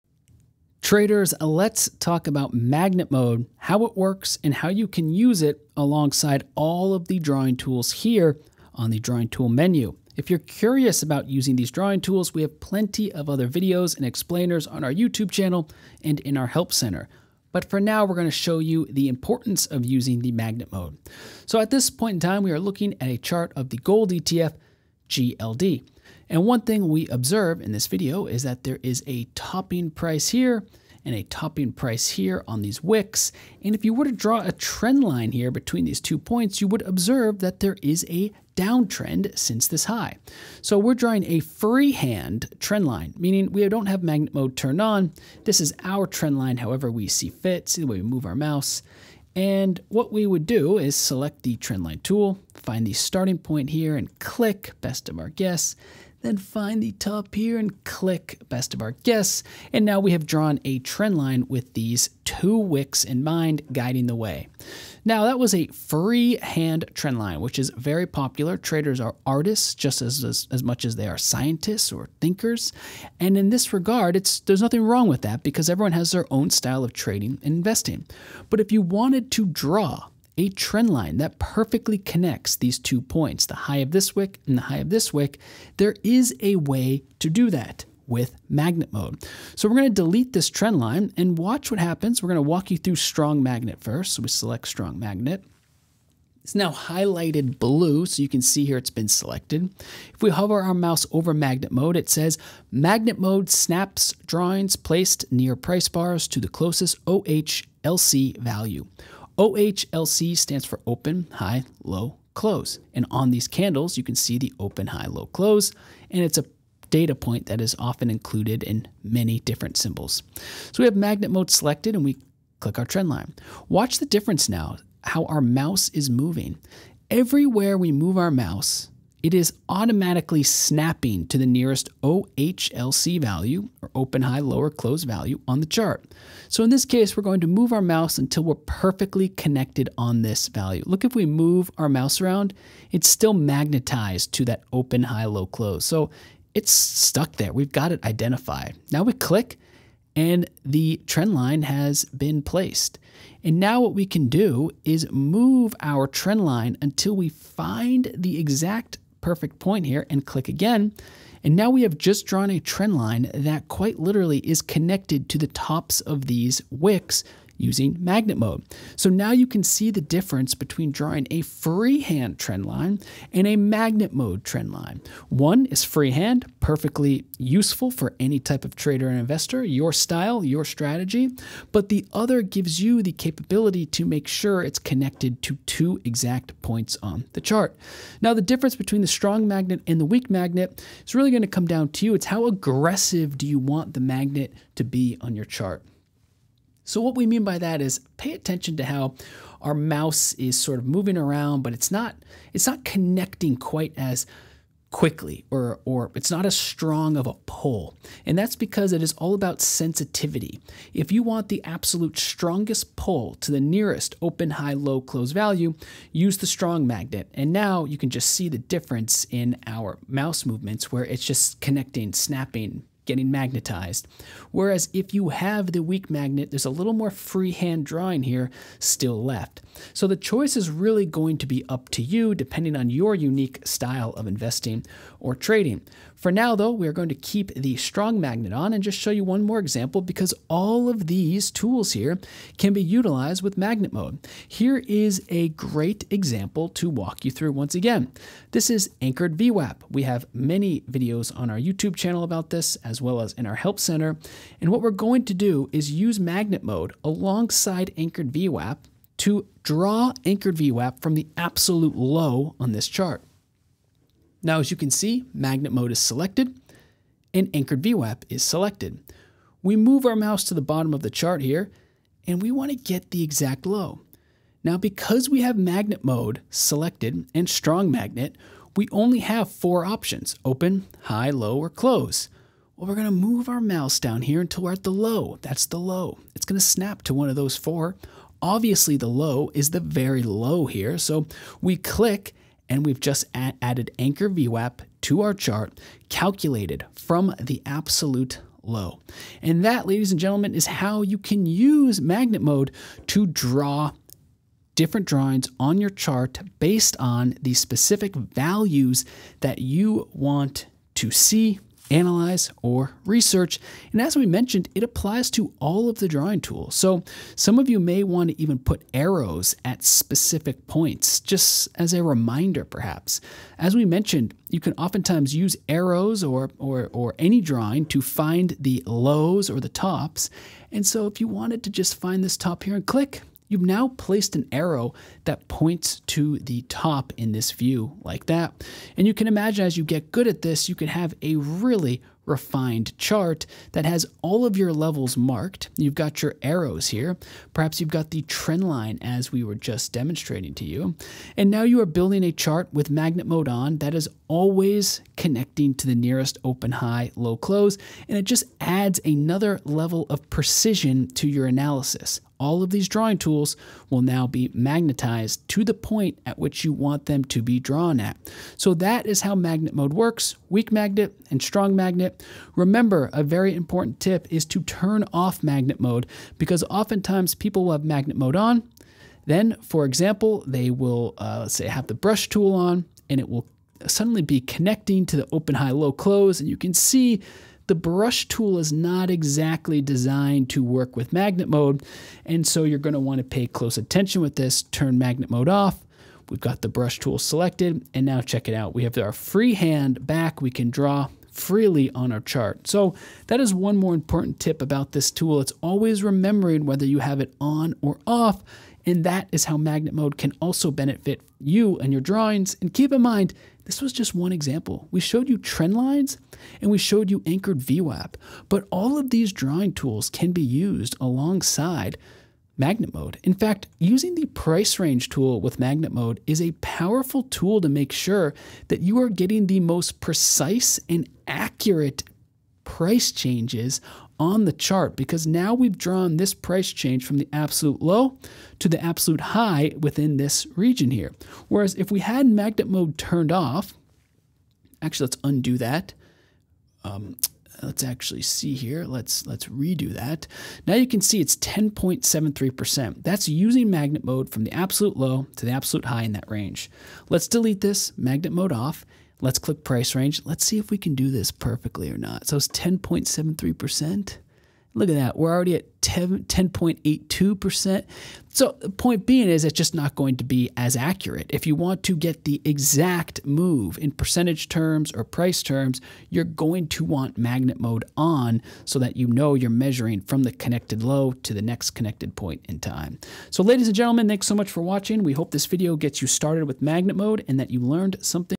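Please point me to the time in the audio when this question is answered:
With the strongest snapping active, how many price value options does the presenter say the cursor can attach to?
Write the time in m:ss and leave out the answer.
4:39.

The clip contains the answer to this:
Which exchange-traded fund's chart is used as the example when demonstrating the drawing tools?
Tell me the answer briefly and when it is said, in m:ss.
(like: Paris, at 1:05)
GLD, at 0:25.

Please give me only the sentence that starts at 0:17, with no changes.
But for now, we're going to show you the importance of using the magnet mode.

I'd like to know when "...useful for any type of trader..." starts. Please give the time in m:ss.
2:57.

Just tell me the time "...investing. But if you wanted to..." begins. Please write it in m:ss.
1:17.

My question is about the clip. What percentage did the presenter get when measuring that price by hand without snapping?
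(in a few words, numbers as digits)
10.82%.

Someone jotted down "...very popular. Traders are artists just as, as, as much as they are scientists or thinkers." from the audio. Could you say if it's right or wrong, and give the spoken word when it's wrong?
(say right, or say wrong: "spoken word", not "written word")
right.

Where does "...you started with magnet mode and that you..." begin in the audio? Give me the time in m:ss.
8:06.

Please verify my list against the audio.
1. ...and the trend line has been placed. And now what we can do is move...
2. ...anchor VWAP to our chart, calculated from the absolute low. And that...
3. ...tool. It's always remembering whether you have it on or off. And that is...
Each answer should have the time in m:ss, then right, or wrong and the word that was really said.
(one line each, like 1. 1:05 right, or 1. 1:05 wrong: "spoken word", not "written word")
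1. 2:30 right
2. 4:53 right
3. 6:45 right.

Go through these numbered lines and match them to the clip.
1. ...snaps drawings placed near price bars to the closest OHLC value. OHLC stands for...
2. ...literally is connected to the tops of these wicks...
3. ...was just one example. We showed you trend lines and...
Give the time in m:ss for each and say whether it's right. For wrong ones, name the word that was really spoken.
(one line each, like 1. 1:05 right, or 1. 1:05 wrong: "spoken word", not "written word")
1. 1:43 right
2. 2:43 right
3. 6:53 right.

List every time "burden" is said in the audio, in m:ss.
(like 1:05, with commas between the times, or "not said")
not said.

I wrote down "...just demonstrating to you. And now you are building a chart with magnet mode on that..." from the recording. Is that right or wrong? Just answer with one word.
right.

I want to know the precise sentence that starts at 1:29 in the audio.
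So we're going to delete this trend line and watch what happens.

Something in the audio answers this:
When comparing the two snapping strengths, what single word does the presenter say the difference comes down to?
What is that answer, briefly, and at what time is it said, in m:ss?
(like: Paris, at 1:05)
Sensitivity, at 3:29.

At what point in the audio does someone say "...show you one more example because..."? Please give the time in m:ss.
3:58.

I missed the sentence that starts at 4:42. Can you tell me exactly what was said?
Well, we're going to move our mouse down here until we're at the low.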